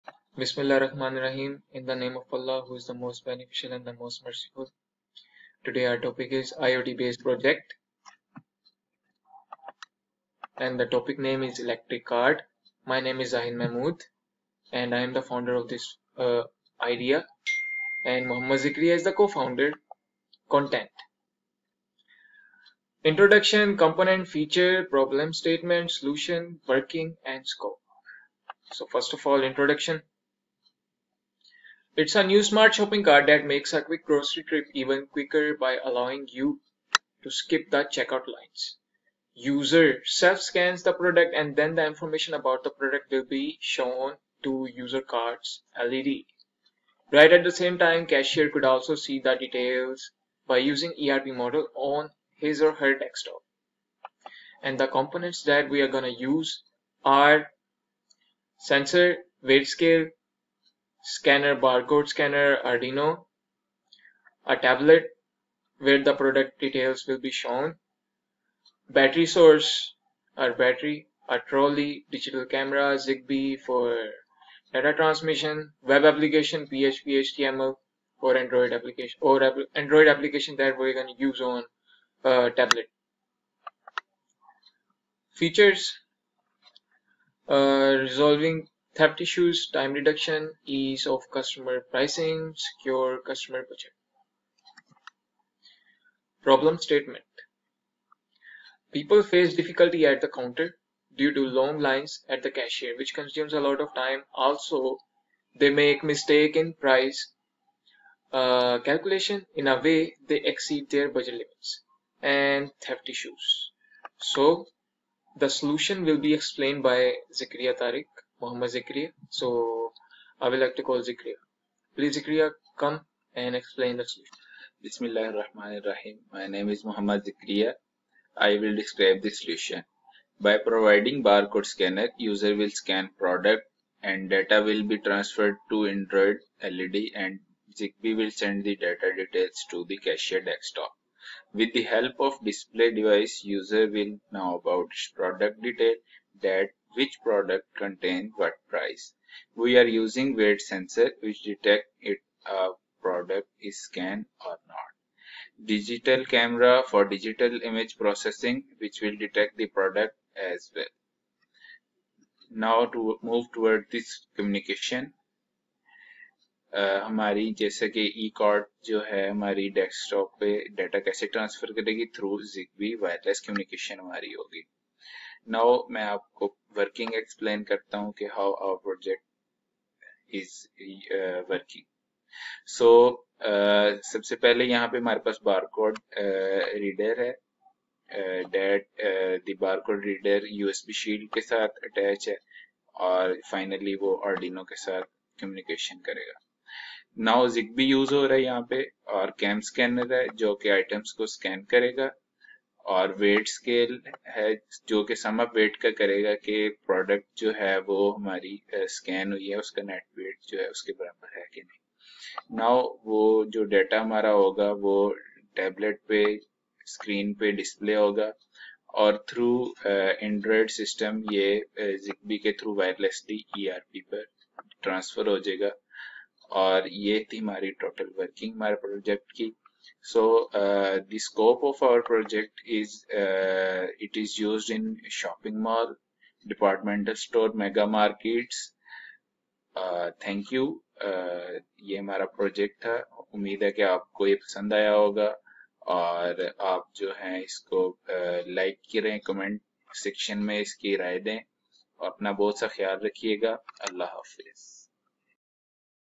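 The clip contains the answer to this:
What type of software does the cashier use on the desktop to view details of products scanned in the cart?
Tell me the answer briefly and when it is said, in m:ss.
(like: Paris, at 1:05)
ERP, at 0:51.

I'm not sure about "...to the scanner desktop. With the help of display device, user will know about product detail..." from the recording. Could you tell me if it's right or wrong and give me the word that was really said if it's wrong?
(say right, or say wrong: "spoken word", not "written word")
wrong: "cashier", not "scanner".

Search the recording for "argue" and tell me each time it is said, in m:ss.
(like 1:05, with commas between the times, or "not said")
not said.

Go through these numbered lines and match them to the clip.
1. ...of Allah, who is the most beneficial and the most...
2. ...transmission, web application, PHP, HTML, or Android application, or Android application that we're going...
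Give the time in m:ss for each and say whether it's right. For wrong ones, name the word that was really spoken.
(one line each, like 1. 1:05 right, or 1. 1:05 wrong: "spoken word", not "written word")
1. 0:02 right
2. 1:14 right.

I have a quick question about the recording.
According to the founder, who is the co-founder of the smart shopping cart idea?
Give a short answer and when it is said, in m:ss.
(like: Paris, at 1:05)
Muhammad Zikri, at 0:18.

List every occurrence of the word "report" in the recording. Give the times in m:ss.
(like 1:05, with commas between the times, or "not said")
not said.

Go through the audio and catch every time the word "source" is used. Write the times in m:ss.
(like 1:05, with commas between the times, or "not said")
1:09.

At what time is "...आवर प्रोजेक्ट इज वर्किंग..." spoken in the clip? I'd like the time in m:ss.
2:58.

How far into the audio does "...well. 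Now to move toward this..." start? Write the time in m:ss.
2:40.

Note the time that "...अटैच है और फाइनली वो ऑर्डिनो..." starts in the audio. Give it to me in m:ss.
3:11.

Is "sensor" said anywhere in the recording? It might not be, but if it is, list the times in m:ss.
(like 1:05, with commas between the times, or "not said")
0:58, 2:30.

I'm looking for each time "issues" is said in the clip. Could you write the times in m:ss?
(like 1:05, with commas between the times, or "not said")
1:29, 1:53.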